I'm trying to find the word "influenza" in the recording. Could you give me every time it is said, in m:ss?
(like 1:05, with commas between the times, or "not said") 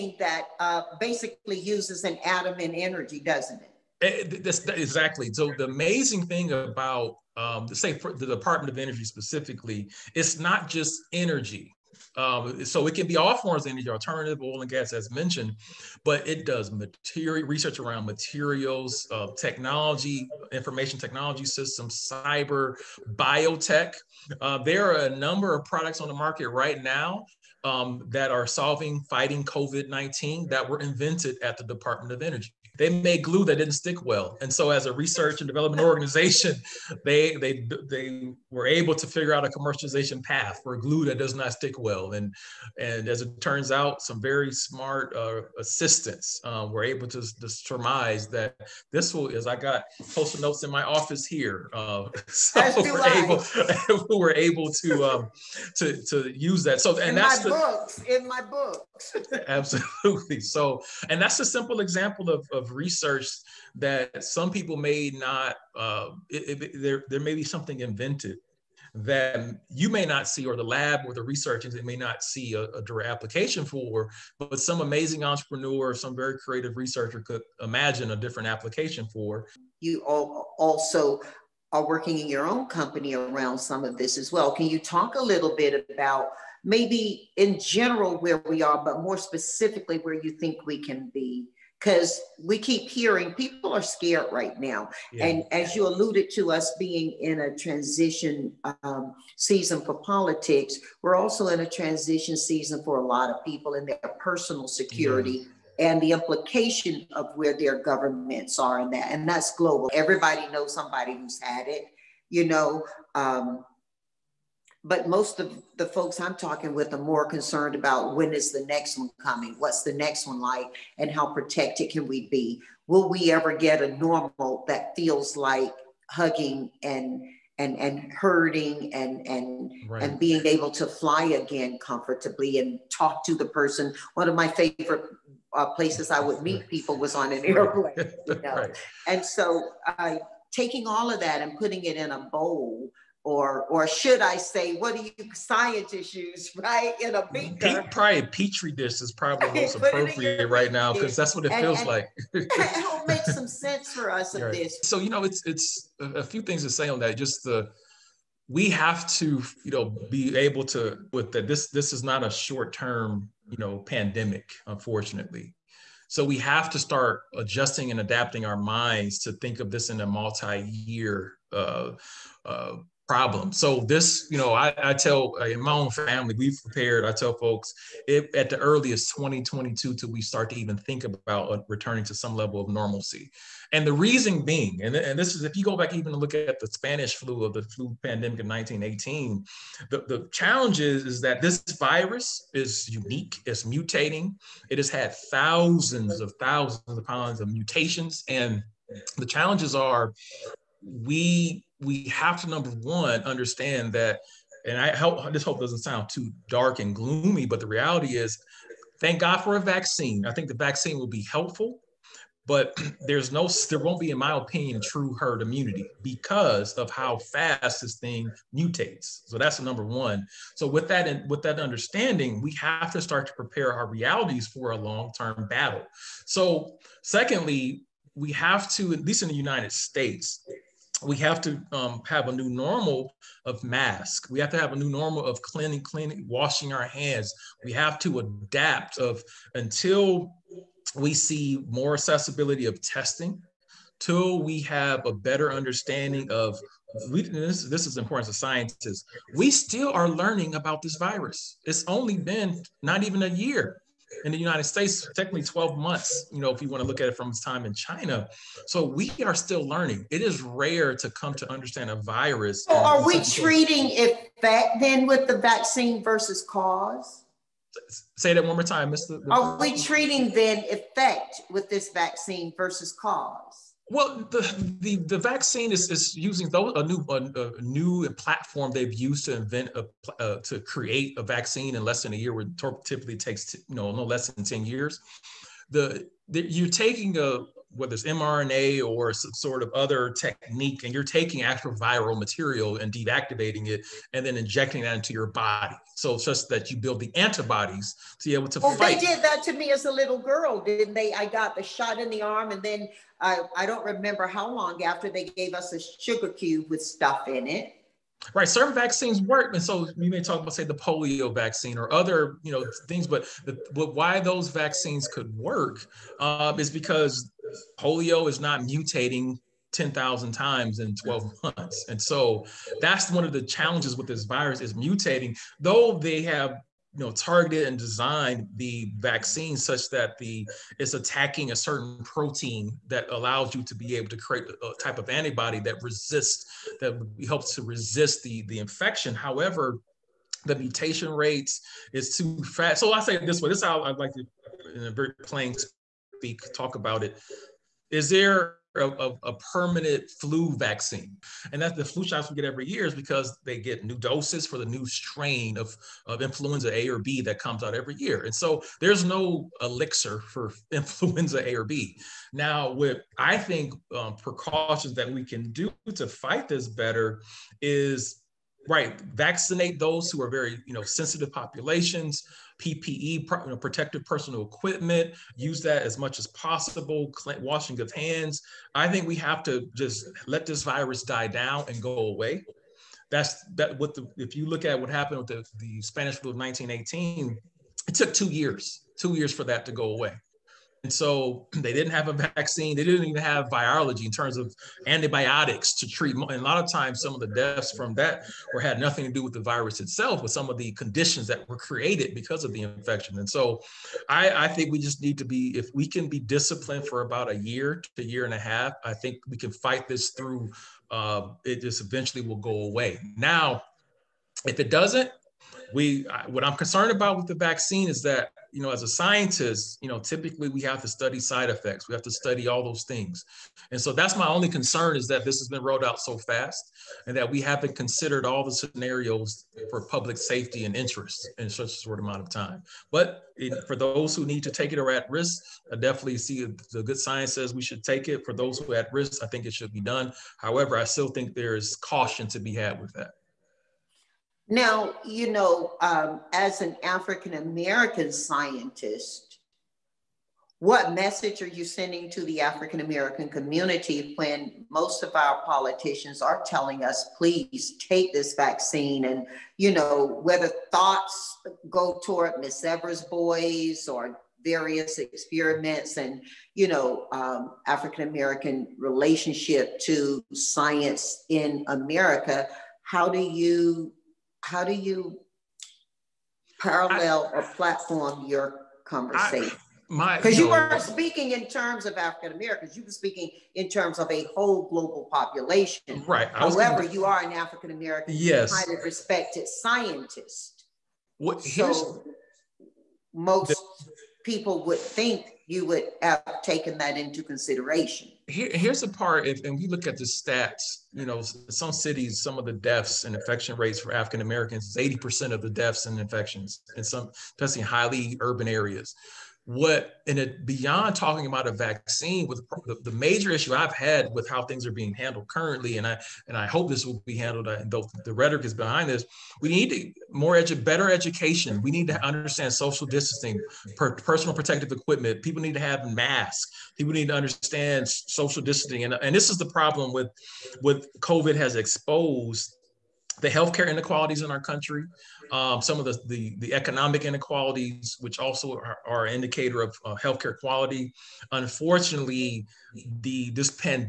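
5:56, 6:00.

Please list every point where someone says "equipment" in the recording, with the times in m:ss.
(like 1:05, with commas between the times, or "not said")
6:14, 8:44.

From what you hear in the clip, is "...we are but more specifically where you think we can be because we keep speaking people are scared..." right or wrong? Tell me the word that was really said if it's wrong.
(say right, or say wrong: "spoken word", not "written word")
wrong: "hearing", not "speaking".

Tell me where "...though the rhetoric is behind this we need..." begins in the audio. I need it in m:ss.
8:37.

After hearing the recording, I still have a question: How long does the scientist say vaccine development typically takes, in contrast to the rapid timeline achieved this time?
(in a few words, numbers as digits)
ten years.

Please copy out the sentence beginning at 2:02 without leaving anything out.
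Will we ever get a normal that feels like hugging and and and hurting and and right.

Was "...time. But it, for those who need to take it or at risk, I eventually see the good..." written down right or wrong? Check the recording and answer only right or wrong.
wrong.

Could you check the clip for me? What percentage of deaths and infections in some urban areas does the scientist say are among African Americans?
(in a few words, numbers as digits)
80%.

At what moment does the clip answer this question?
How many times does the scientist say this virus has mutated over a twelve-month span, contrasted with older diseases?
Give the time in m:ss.
5:19.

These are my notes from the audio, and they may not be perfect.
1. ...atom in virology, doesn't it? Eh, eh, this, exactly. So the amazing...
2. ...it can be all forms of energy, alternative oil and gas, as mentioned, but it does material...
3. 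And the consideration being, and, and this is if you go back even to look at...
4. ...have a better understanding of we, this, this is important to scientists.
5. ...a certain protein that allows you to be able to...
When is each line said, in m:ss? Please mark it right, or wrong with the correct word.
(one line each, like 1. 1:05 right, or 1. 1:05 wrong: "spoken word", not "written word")
1. 0:02 wrong: "energy", not "virology"
2. 0:12 right
3. 3:03 wrong: "reason", not "consideration"
4. 4:04 right
5. 5:31 right.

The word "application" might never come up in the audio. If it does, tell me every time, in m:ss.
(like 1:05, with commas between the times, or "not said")
1:13, 1:18.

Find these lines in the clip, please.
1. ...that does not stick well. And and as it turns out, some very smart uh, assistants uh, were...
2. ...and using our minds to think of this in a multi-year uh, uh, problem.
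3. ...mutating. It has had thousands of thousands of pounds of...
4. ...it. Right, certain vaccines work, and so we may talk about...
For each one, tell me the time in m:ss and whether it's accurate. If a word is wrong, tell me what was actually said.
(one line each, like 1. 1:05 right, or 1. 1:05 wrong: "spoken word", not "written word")
1. 0:41 right
2. 2:47 wrong: "adapting", not "using"
3. 3:13 right
4. 5:07 right.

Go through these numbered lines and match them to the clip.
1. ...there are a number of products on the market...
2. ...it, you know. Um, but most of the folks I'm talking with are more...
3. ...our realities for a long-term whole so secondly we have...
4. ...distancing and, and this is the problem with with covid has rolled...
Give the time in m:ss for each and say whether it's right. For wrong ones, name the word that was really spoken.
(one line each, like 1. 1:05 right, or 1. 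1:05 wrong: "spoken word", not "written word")
1. 0:24 right
2. 1:51 right
3. 3:43 wrong: "battle", not "whole"
4. 8:48 wrong: "exposed", not "rolled".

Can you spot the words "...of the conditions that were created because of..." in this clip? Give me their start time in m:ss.
6:40.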